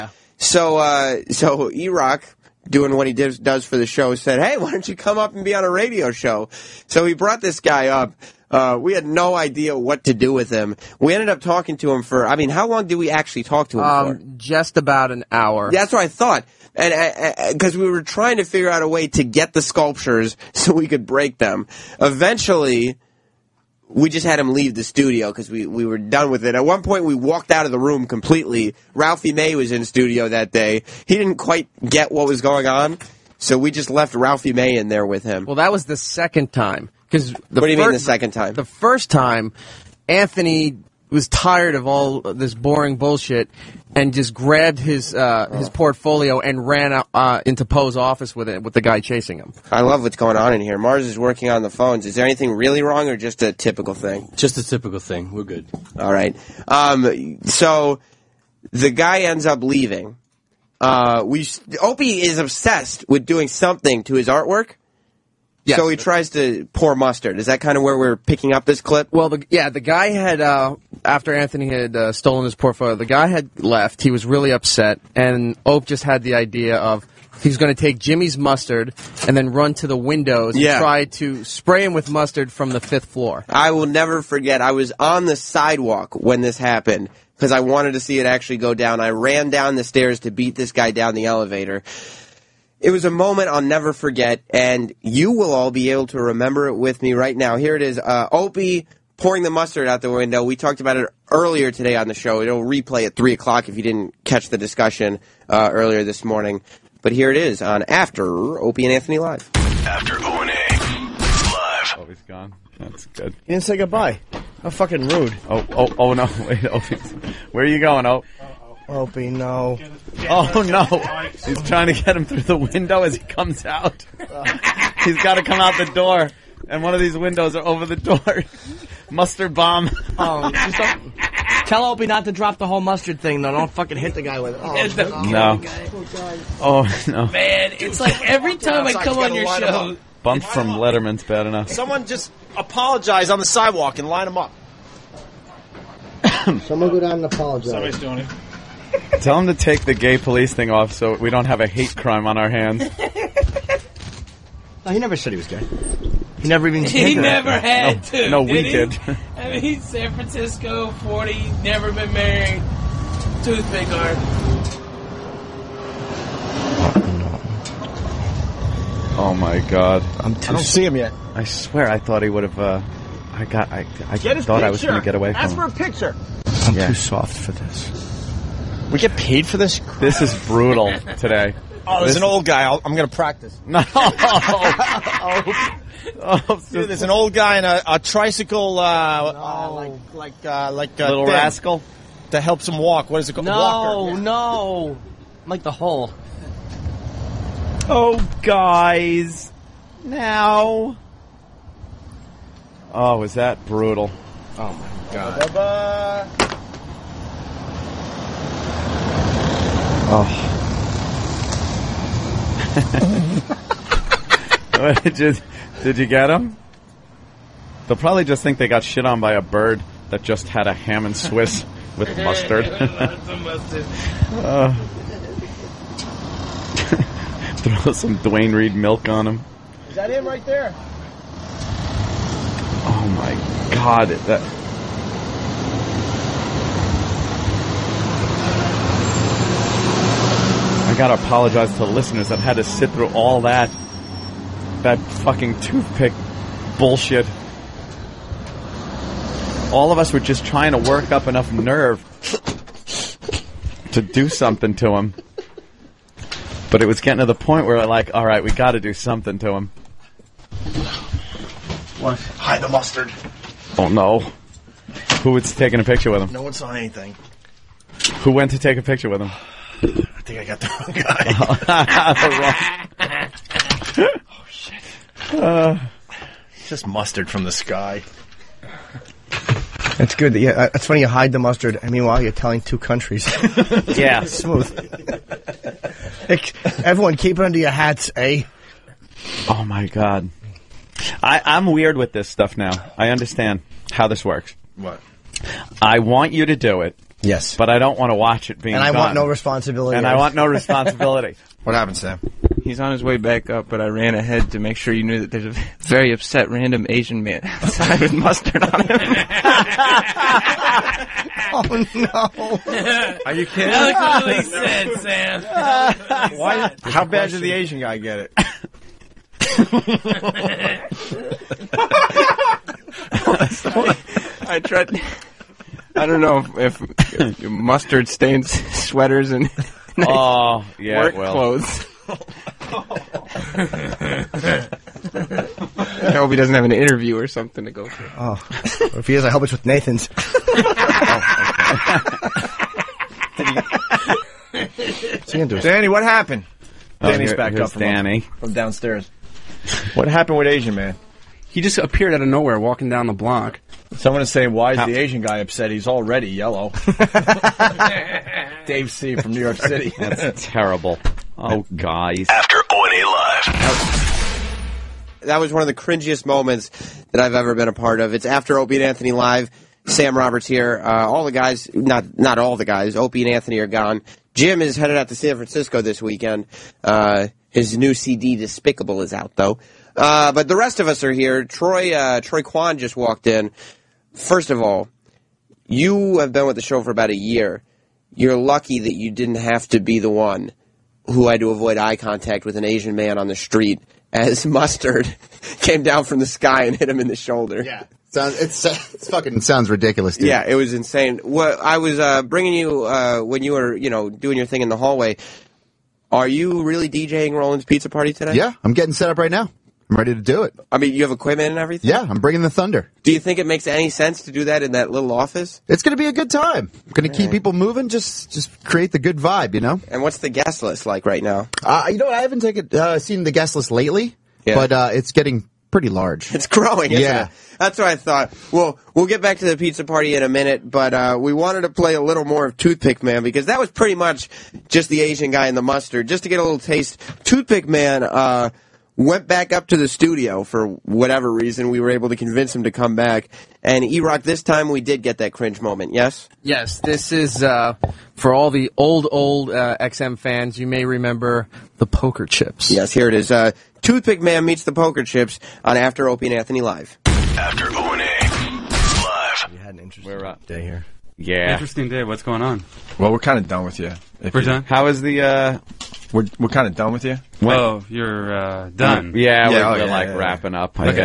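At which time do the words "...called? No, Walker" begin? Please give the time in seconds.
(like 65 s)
193 s.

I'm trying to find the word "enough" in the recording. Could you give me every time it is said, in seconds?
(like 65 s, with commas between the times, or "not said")
141 s, 251 s.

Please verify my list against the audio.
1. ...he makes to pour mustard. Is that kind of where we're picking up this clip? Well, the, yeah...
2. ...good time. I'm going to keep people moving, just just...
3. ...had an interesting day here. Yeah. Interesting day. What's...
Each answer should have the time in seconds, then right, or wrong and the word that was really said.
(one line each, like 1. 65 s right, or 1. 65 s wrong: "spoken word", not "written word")
1. 65 s wrong: "tries", not "makes"
2. 416 s right
3. 459 s right.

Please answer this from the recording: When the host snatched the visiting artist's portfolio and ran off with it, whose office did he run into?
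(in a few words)
Poe's office.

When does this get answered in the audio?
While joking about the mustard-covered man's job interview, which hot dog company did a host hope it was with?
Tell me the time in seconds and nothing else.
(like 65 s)
339 s.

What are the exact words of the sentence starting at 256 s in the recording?
But it was getting to the point where, like, alright, we gotta do something to him.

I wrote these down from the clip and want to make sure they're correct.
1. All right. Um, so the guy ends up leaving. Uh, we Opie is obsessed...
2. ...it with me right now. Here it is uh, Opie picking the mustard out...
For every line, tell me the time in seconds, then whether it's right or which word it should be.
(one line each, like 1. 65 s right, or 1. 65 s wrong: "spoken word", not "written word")
1. 55 s right
2. 96 s wrong: "pouring", not "picking".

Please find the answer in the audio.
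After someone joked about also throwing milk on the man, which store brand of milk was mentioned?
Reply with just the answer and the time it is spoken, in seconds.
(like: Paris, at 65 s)
Duane Reade, at 228 s.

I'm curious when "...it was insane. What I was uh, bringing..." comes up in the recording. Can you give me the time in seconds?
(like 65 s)
400 s.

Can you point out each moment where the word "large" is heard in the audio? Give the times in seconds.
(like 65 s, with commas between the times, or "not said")
425 s.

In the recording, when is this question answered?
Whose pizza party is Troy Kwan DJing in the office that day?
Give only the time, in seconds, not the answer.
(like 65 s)
407 s.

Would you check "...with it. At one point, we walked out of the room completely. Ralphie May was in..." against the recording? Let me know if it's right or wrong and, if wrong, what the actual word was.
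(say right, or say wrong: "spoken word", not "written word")
right.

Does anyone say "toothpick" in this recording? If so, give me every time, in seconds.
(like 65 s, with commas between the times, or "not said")
163 s, 245 s, 432 s, 437 s, 453 s.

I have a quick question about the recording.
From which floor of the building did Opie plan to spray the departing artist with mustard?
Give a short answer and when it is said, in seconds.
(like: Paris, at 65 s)
fifth floor, at 82 s.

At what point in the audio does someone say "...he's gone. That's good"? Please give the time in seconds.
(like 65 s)
112 s.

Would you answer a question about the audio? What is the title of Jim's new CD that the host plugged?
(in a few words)
Despicable.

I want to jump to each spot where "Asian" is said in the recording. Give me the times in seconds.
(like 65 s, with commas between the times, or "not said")
306 s, 317 s, 350 s, 354 s, 392 s, 434 s.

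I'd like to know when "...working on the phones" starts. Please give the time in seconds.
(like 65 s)
51 s.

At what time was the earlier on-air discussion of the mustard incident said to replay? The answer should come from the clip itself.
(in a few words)
3 o'clock.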